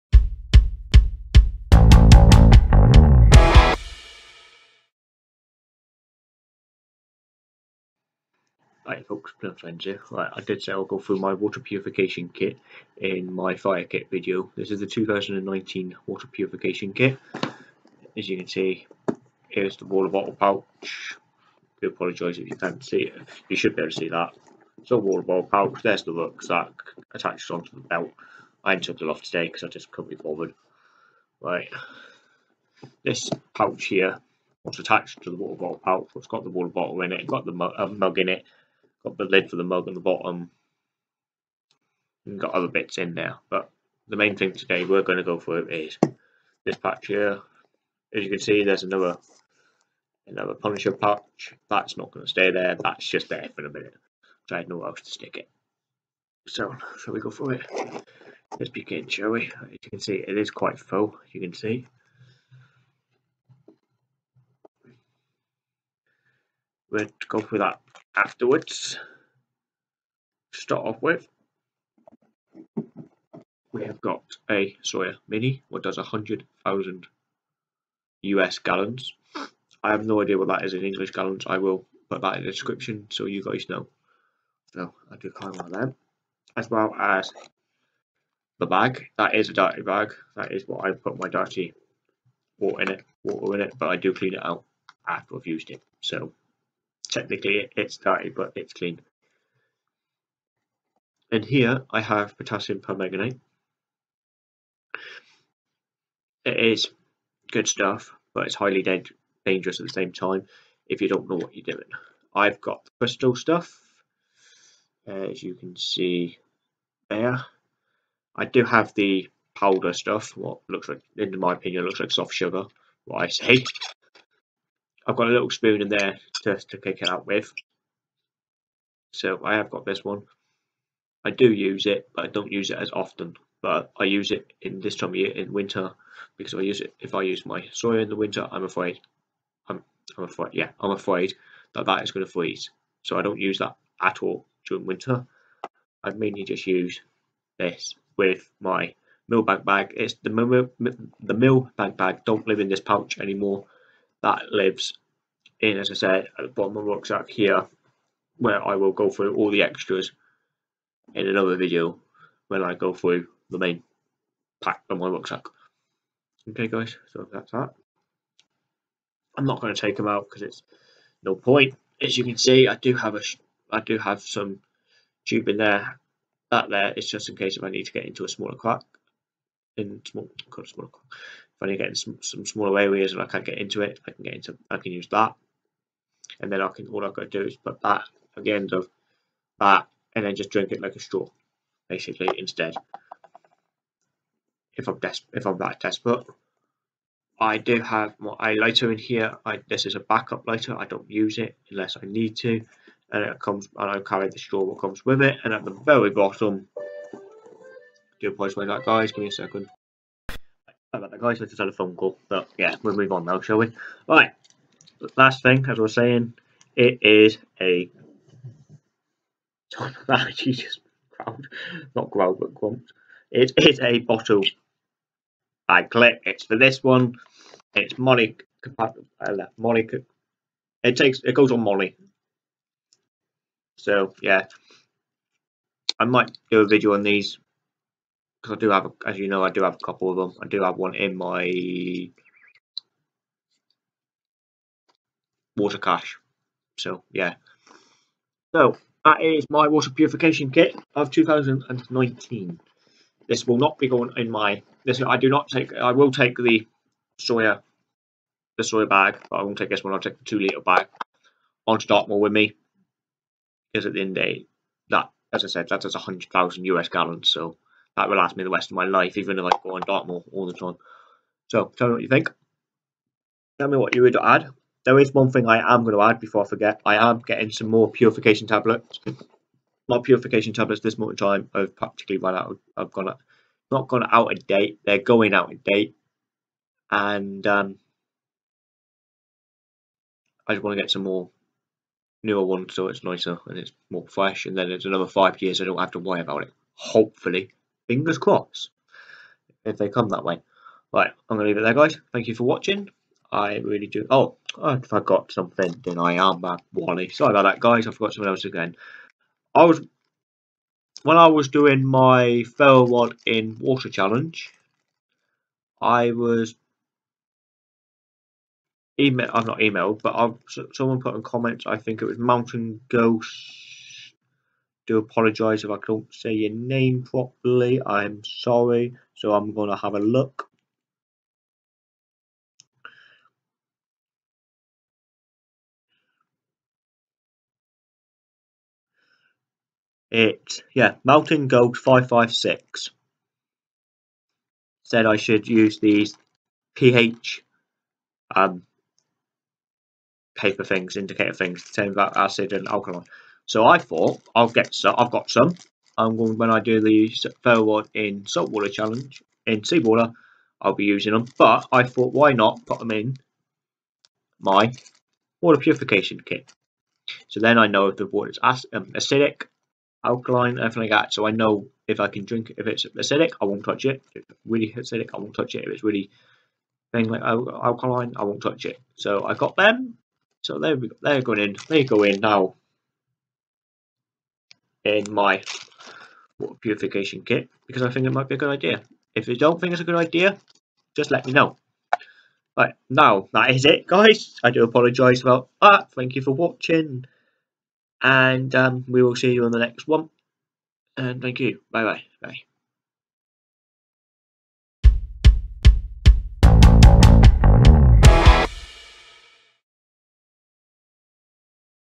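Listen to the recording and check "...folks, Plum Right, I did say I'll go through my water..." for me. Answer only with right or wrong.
right.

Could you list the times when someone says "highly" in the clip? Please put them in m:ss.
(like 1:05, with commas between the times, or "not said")
1:48.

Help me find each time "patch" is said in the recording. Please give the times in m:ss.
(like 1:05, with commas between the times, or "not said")
0:46, 0:50.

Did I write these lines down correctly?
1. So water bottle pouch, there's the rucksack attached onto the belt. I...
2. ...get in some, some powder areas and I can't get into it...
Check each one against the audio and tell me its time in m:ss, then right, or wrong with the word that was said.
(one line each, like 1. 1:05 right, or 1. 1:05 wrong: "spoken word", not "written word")
1. 0:24 right
2. 3:01 wrong: "smaller", not "powder".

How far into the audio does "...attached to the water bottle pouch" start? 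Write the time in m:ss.
0:34.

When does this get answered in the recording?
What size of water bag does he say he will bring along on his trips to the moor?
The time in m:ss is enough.
4:20.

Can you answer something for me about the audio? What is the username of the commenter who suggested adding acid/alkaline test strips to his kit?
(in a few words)
Mountain Goat 556.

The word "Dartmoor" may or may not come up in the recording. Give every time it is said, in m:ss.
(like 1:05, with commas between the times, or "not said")
4:21, 4:29.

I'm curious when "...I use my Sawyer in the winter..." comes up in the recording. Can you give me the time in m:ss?
2:17.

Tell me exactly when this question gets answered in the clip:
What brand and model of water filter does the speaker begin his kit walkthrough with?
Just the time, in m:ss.
1:14.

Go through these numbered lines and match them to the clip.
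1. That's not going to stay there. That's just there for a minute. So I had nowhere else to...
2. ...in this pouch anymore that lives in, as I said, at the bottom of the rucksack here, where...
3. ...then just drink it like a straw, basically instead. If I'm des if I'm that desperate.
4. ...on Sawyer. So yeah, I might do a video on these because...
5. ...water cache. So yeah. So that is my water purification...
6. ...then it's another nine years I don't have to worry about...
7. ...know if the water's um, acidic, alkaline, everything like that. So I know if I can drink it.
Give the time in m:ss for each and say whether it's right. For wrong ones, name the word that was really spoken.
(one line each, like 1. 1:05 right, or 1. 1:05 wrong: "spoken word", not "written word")
1. 0:51 right
2. 2:32 right
3. 3:10 right
4. 3:51 wrong: "MOLLE", not "Sawyer"
5. 4:05 right
6. 4:54 wrong: "five", not "nine"
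7. 6:07 right.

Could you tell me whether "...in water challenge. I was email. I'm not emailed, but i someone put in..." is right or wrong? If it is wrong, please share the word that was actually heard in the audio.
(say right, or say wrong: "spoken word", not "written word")
right.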